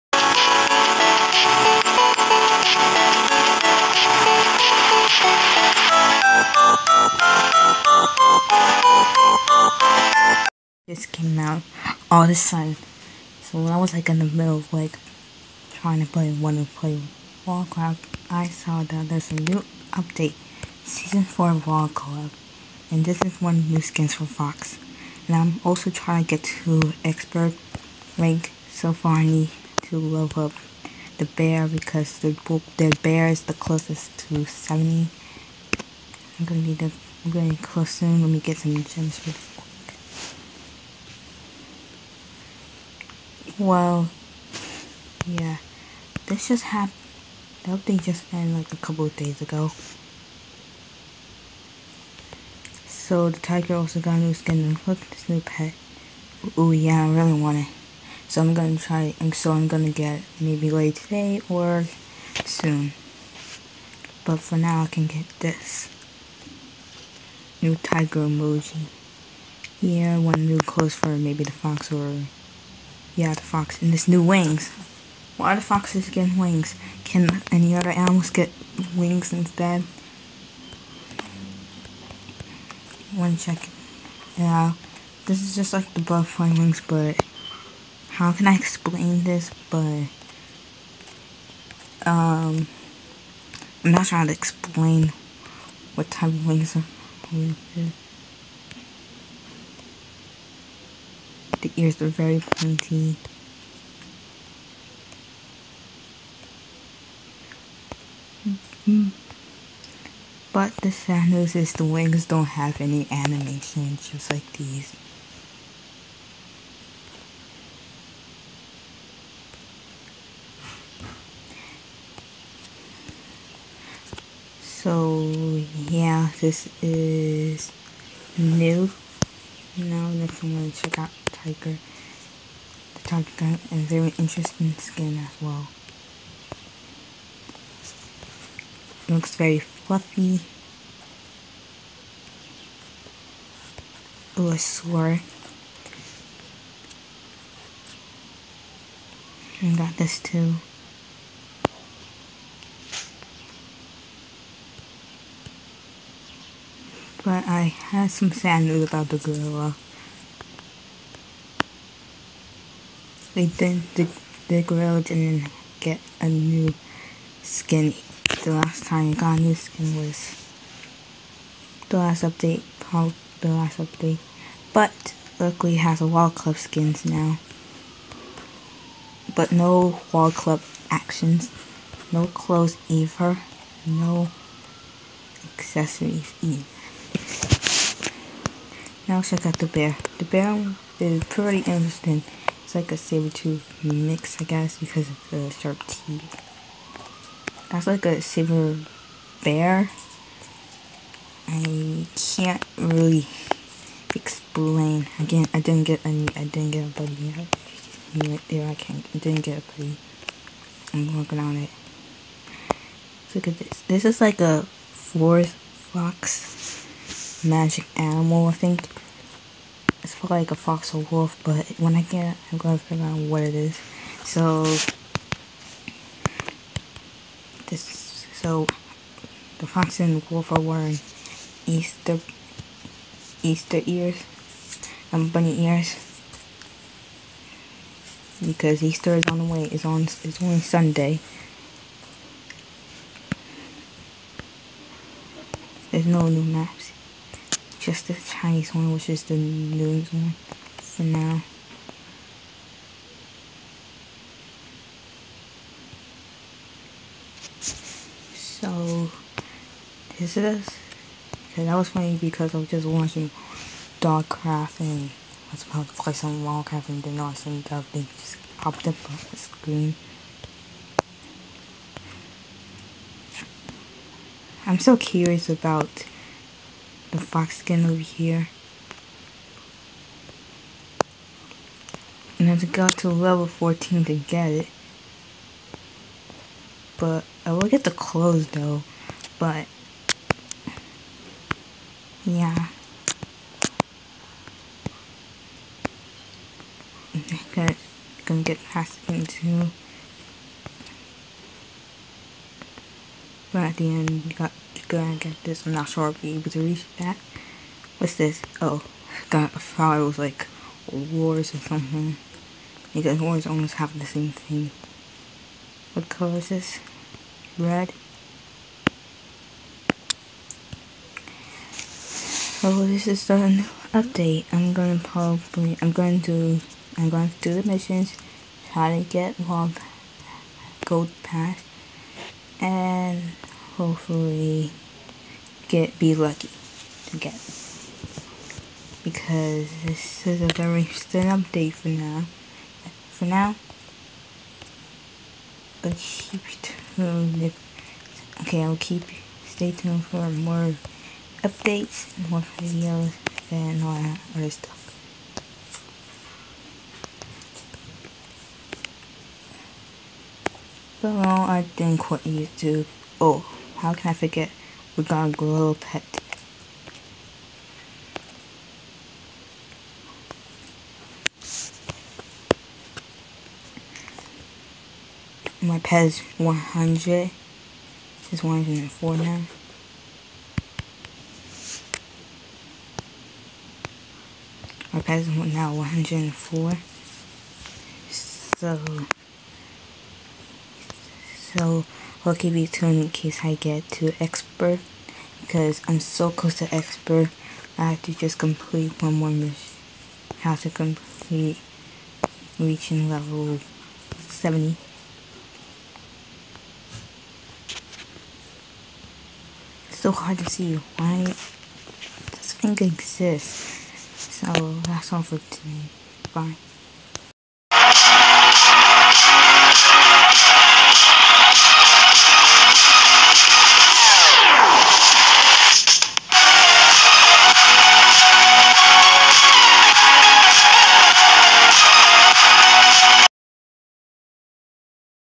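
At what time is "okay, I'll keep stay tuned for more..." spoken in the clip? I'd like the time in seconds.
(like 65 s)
348 s.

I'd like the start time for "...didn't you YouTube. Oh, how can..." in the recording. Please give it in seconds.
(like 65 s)
361 s.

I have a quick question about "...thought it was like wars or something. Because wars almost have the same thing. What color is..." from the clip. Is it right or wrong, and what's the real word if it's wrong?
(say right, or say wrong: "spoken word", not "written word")
right.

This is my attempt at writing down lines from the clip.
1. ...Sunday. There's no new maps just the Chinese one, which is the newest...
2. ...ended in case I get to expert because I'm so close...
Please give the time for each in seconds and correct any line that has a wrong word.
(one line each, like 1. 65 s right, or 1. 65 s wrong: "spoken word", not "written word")
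1. 240 s right
2. 392 s wrong: "tuned", not "ended".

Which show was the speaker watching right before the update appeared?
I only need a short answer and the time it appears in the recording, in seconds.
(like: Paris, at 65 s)
Dogcraft, at 263 s.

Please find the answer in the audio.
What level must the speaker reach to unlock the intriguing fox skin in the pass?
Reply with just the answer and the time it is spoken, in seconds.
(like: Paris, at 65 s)
14, at 283 s.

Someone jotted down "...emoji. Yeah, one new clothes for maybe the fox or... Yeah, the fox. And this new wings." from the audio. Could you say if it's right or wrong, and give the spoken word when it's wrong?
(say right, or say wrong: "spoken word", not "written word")
right.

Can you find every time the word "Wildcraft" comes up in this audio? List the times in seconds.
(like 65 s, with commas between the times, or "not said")
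17 s, 21 s, 266 s.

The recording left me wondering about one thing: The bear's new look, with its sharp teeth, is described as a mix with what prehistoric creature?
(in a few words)
Saber tooth.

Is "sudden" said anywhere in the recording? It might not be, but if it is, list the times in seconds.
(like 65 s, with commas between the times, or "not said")
12 s, 267 s.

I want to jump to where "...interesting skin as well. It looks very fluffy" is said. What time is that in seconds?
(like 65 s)
134 s.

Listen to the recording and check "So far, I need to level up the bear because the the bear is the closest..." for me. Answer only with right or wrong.
right.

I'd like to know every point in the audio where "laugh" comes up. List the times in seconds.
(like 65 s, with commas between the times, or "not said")
not said.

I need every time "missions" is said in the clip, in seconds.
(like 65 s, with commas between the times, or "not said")
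327 s, 399 s.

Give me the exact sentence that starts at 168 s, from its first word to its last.
The last time it got a new skin was the last update, called the last update.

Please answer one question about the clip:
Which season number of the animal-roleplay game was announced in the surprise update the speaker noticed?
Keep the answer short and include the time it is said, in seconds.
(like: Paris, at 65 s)
4, at 20 s.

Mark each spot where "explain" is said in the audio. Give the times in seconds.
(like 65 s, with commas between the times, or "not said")
88 s, 94 s, 204 s.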